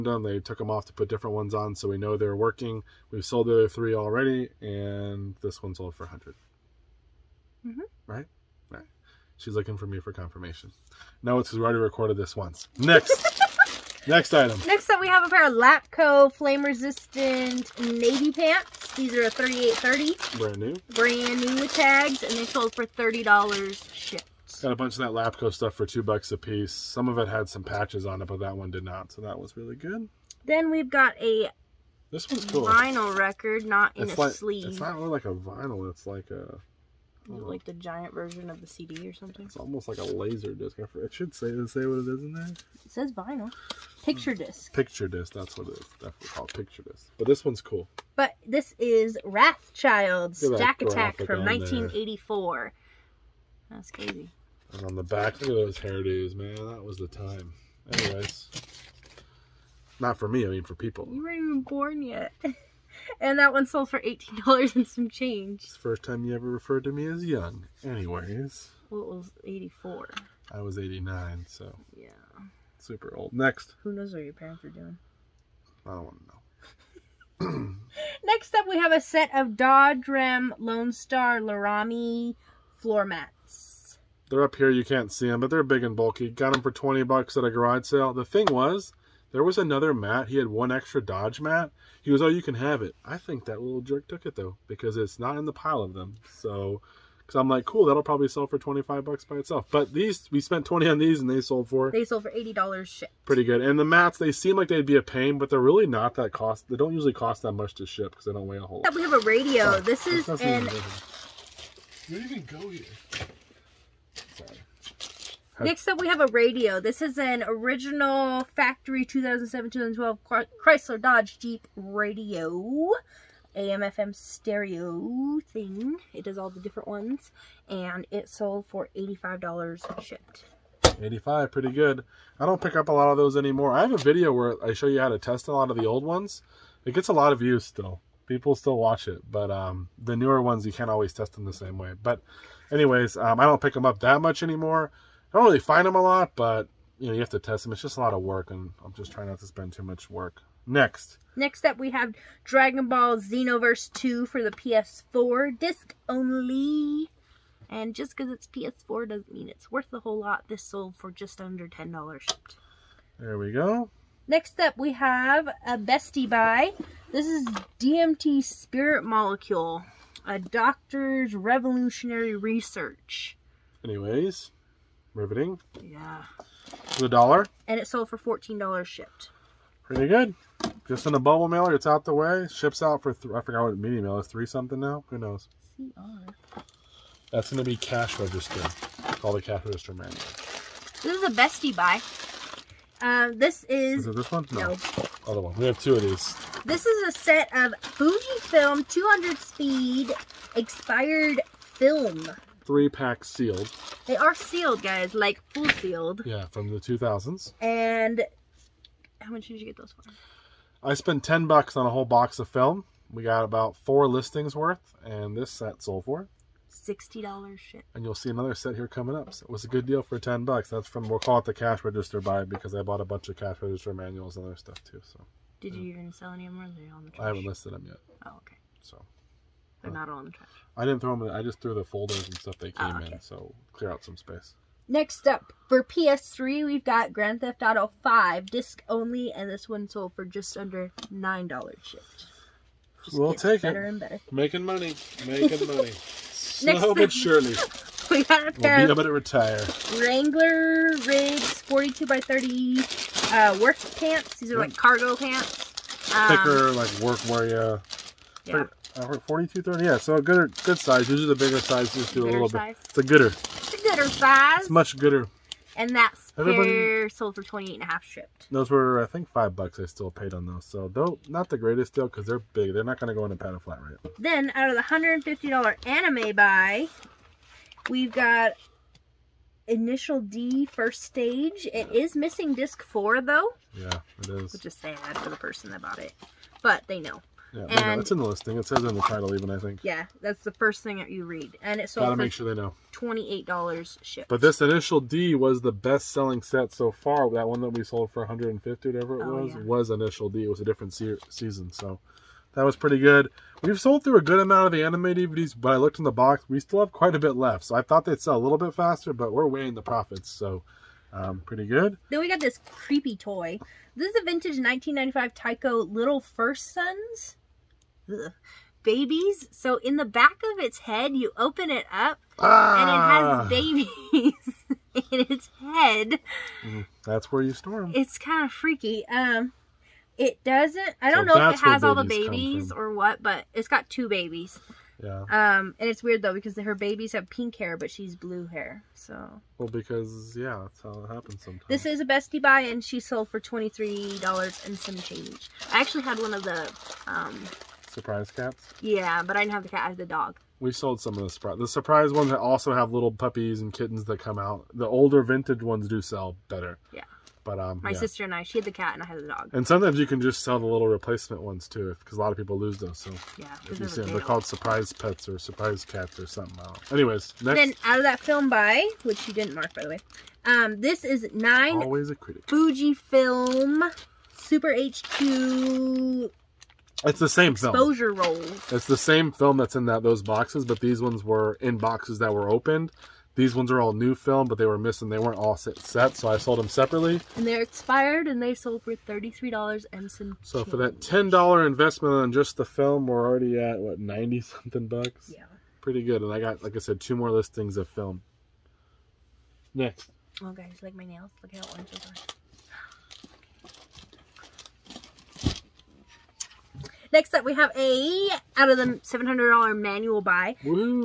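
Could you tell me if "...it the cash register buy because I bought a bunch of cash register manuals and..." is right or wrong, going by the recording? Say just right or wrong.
right.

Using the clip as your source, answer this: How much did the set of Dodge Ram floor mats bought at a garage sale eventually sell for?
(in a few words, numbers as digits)
$80.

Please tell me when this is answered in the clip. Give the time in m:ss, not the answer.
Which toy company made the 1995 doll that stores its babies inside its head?
5:15.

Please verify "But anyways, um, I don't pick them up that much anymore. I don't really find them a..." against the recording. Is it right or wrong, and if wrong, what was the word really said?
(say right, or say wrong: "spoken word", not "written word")
right.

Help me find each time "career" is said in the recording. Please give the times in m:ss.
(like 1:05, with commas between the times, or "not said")
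not said.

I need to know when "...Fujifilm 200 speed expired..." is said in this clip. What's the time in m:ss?
3:17.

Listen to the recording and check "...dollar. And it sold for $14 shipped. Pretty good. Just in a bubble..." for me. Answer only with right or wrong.
right.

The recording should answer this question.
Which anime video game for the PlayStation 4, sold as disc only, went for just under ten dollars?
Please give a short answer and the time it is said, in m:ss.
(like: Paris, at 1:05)
Dragon Ball Xenoverse 2, at 2:32.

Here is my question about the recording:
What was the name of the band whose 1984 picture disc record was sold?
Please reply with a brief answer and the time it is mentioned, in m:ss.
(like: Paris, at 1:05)
Wrathchild, at 0:49.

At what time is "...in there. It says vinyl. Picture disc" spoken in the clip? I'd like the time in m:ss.
0:42.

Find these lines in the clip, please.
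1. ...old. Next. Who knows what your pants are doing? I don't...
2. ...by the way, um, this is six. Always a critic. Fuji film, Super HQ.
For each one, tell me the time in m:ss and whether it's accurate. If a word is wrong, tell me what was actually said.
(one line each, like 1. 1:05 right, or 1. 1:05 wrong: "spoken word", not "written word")
1. 1:13 wrong: "parents", not "pants"
2. 6:09 wrong: "nine", not "six".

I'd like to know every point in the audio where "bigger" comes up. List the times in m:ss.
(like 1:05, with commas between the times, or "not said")
4:21.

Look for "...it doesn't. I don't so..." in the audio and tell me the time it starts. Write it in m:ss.
5:30.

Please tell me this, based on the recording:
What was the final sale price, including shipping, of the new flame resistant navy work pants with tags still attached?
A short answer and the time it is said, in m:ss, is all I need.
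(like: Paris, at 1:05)
$30, at 0:22.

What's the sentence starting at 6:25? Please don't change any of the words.
They weren't all set, set so I sold them separately.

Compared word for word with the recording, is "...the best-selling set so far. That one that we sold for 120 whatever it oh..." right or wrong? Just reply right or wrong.
wrong.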